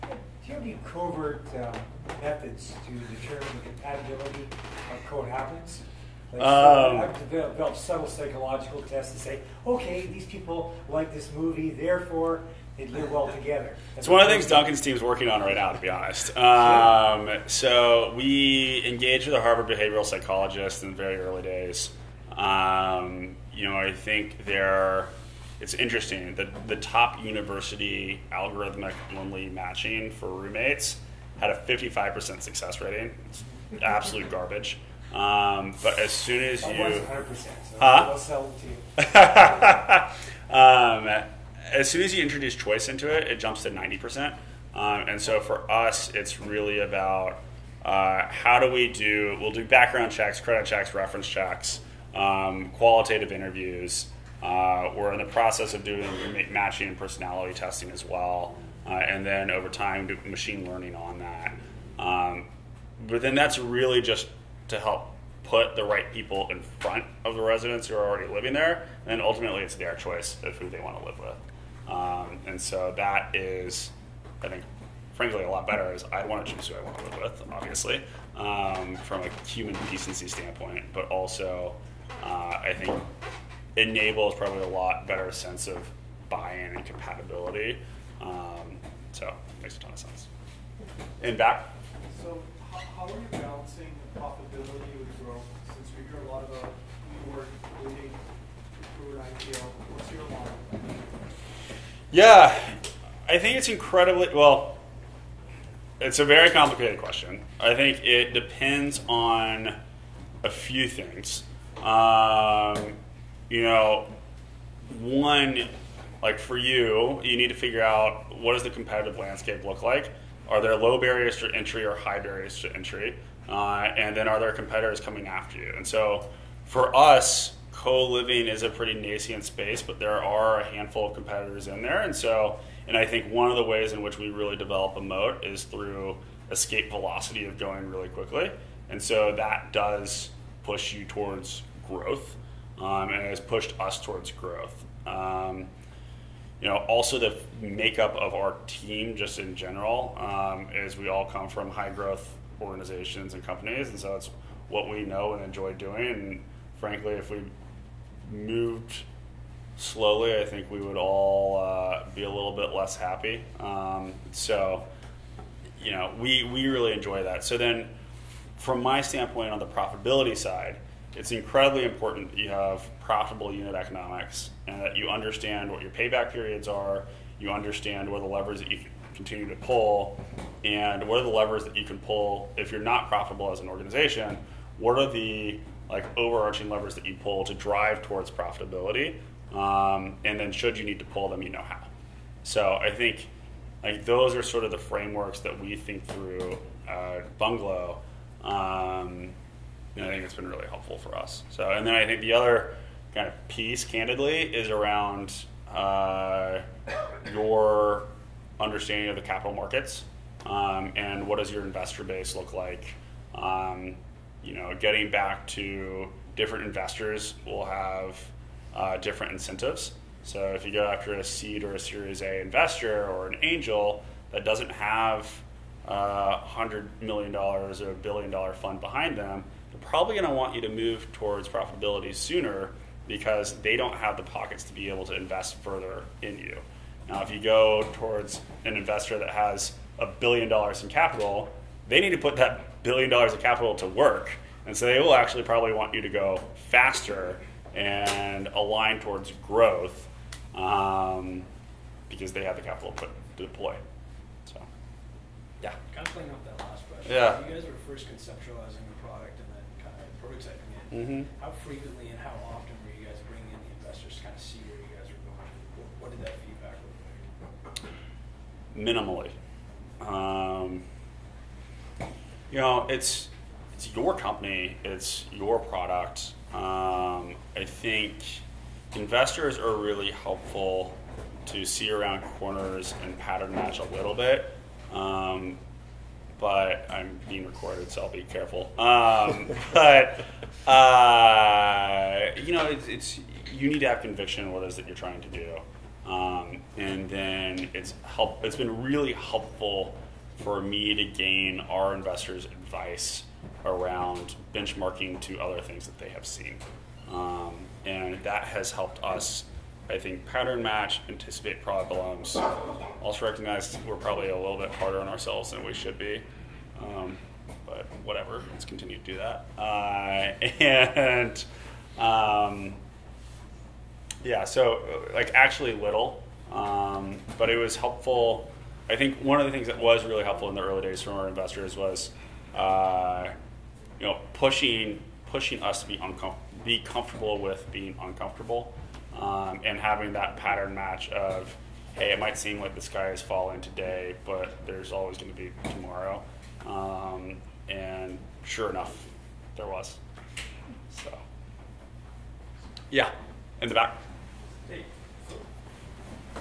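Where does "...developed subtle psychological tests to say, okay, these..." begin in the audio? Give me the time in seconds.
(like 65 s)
7 s.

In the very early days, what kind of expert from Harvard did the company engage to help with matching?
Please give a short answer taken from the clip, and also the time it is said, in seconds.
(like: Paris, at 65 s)
behavioral psychologist, at 19 s.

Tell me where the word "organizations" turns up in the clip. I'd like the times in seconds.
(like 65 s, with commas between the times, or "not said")
152 s, 183 s.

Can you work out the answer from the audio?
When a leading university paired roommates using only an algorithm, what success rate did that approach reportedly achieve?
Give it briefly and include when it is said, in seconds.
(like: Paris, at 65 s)
55%, at 31 s.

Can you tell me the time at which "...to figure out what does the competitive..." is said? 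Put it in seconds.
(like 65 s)
117 s.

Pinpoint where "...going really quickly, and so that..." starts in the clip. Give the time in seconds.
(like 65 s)
137 s.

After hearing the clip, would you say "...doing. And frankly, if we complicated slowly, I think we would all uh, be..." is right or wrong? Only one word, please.
wrong.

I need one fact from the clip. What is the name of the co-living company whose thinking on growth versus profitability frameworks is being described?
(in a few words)
Bungalow.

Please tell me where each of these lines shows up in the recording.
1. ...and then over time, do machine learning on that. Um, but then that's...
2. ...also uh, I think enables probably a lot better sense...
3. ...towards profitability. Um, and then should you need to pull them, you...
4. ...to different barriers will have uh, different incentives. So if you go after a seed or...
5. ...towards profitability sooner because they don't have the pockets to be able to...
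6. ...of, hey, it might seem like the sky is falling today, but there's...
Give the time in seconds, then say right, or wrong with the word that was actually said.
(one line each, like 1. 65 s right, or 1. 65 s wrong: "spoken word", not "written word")
1. 58 s right
2. 81 s right
3. 188 s right
4. 215 s wrong: "investors", not "barriers"
5. 231 s right
6. 341 s right.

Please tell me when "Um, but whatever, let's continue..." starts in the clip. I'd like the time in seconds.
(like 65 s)
316 s.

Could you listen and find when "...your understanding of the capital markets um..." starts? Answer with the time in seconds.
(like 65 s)
207 s.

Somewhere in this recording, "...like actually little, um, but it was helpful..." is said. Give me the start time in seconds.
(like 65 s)
325 s.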